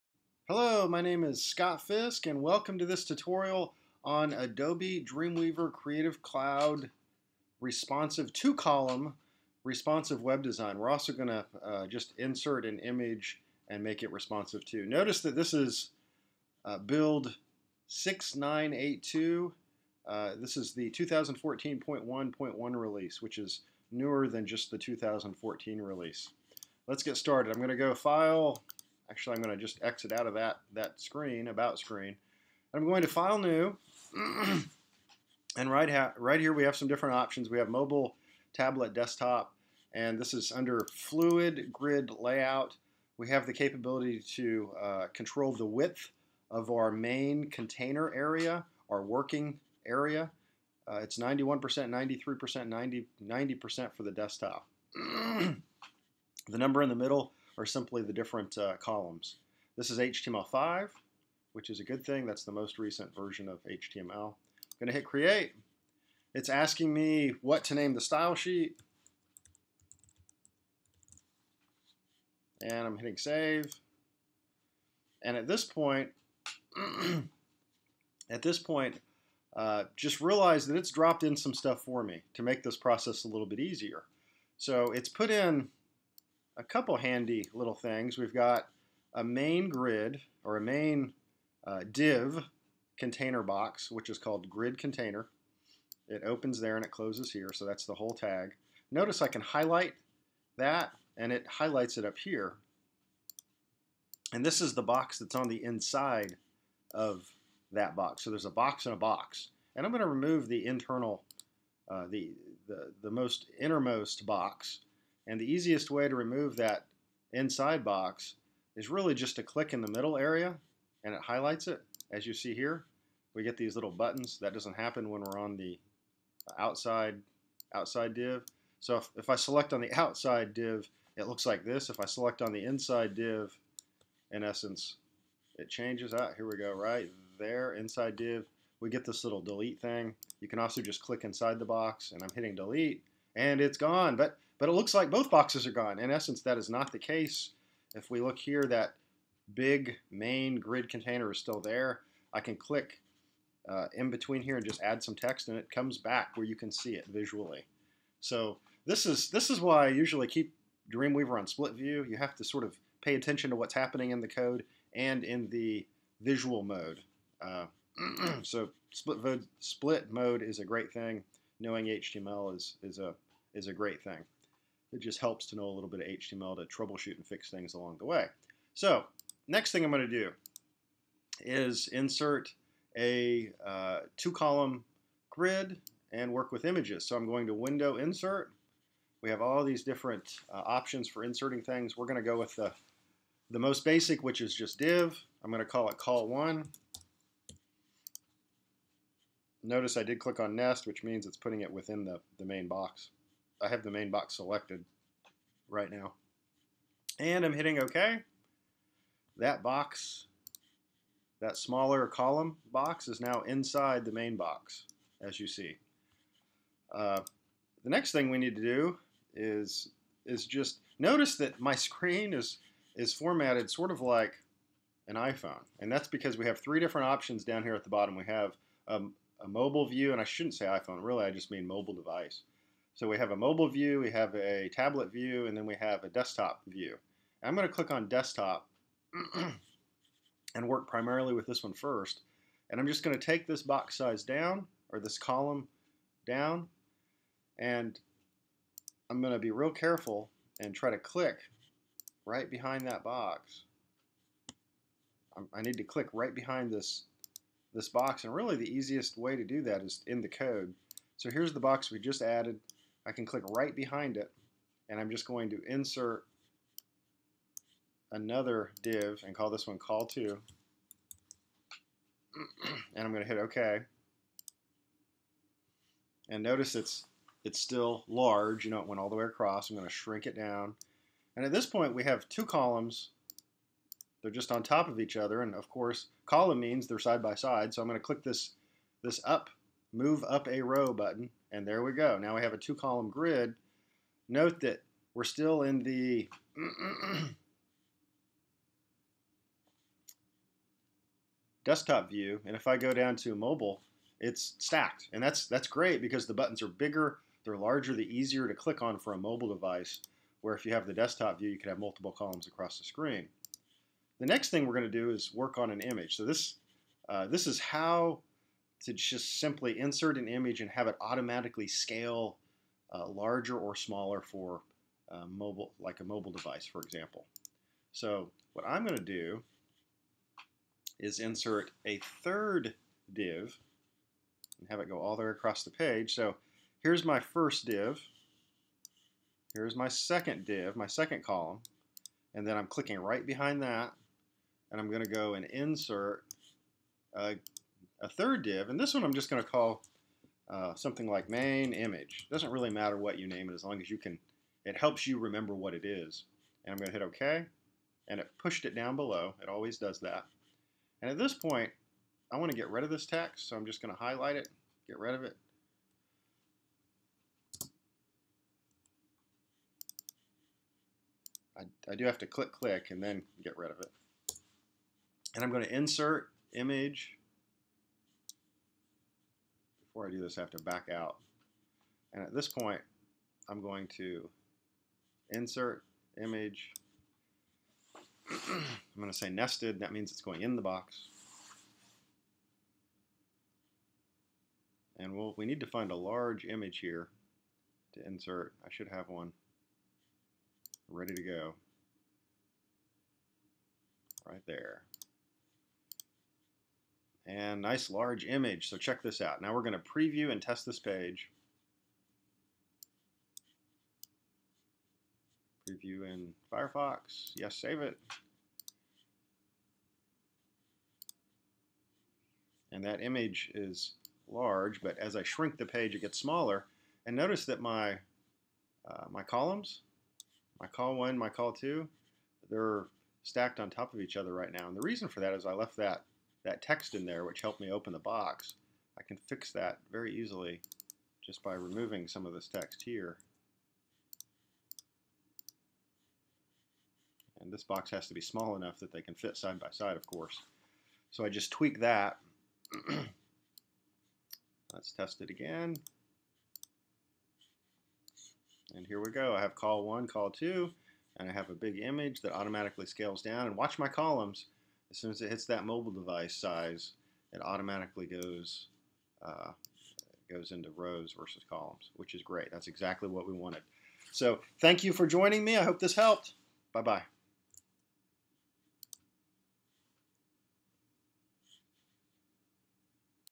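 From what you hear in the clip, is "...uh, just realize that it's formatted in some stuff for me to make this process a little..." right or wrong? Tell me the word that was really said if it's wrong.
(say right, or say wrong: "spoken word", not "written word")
wrong: "dropped", not "formatted".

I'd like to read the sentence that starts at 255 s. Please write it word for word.
I need to click right behind this this box, and really the easiest way to do that is in the code.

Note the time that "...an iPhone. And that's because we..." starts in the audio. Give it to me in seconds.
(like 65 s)
225 s.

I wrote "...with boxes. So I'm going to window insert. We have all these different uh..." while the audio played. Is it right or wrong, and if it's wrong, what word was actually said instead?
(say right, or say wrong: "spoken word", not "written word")
wrong: "images", not "boxes".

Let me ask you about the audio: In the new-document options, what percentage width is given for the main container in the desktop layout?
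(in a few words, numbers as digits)
90%.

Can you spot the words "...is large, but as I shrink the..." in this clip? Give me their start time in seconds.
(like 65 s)
423 s.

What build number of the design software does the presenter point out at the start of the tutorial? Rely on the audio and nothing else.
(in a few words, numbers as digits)
6982.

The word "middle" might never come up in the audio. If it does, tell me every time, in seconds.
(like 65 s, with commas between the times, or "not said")
56 s, 119 s.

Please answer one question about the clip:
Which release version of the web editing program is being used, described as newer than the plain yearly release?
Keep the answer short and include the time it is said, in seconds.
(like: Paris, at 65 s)
2014.1.1, at 20 s.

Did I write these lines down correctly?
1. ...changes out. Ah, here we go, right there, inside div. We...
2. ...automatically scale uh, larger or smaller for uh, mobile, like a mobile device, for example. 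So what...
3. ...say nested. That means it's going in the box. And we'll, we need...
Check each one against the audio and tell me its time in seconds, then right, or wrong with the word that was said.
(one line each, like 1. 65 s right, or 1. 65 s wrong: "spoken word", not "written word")
1. 135 s right
2. 321 s right
3. 389 s right.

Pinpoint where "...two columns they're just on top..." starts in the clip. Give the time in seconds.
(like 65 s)
282 s.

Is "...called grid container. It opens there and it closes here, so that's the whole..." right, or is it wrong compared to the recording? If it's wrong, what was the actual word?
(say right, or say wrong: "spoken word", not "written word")
right.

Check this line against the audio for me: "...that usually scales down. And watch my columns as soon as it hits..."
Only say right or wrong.
wrong.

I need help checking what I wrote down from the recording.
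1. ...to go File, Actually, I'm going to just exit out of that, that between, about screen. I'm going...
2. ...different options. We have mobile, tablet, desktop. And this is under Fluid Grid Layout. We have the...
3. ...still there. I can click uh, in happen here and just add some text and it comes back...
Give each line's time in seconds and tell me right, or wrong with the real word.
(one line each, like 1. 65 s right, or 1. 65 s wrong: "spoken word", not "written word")
1. 27 s wrong: "screen", not "between"
2. 36 s right
3. 151 s wrong: "between", not "happen".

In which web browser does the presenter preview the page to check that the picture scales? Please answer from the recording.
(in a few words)
Firefox.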